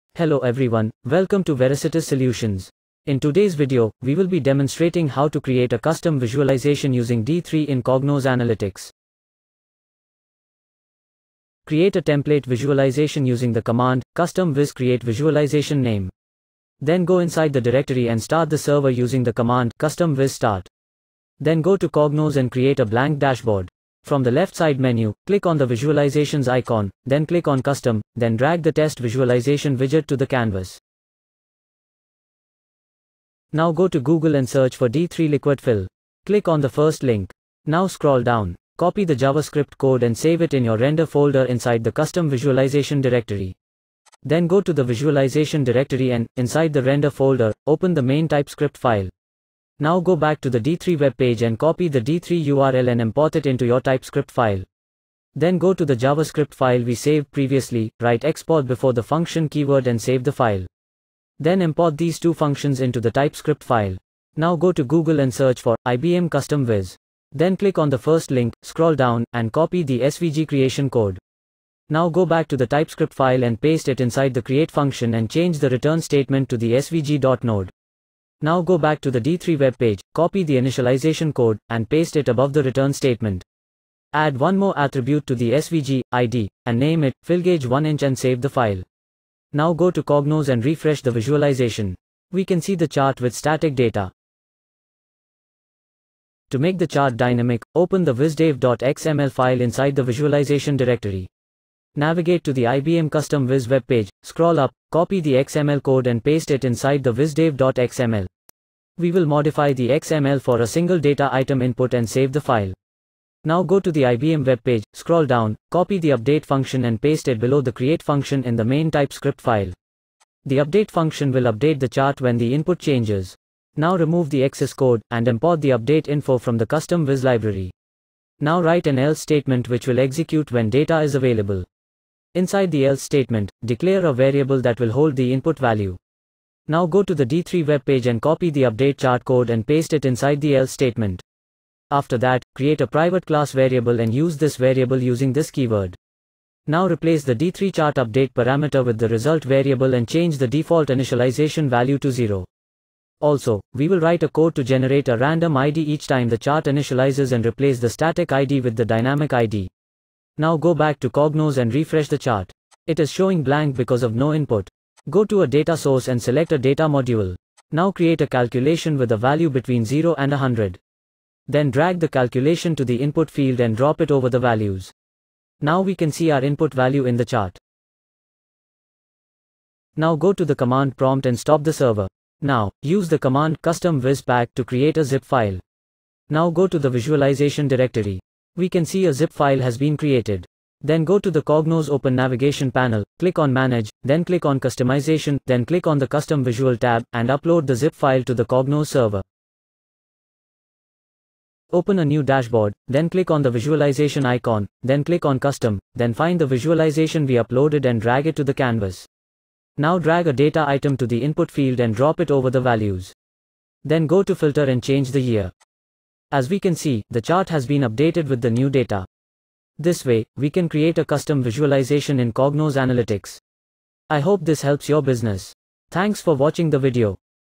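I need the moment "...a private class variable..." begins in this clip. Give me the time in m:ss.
2:22.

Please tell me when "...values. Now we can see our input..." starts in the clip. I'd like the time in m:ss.
2:54.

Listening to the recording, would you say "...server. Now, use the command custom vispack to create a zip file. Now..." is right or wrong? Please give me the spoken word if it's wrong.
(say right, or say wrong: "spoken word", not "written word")
right.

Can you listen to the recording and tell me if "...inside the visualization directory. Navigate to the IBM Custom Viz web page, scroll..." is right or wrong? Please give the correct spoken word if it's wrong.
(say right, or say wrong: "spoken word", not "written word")
right.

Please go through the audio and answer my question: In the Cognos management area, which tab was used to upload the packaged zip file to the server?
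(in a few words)
Custom Visual.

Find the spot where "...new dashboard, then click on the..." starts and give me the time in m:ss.
3:22.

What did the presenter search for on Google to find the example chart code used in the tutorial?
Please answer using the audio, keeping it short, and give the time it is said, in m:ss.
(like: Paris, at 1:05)
D3 liquid fill, at 0:34.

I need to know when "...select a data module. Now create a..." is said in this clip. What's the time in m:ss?
2:46.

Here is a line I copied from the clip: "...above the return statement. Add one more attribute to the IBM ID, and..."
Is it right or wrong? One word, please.
wrong.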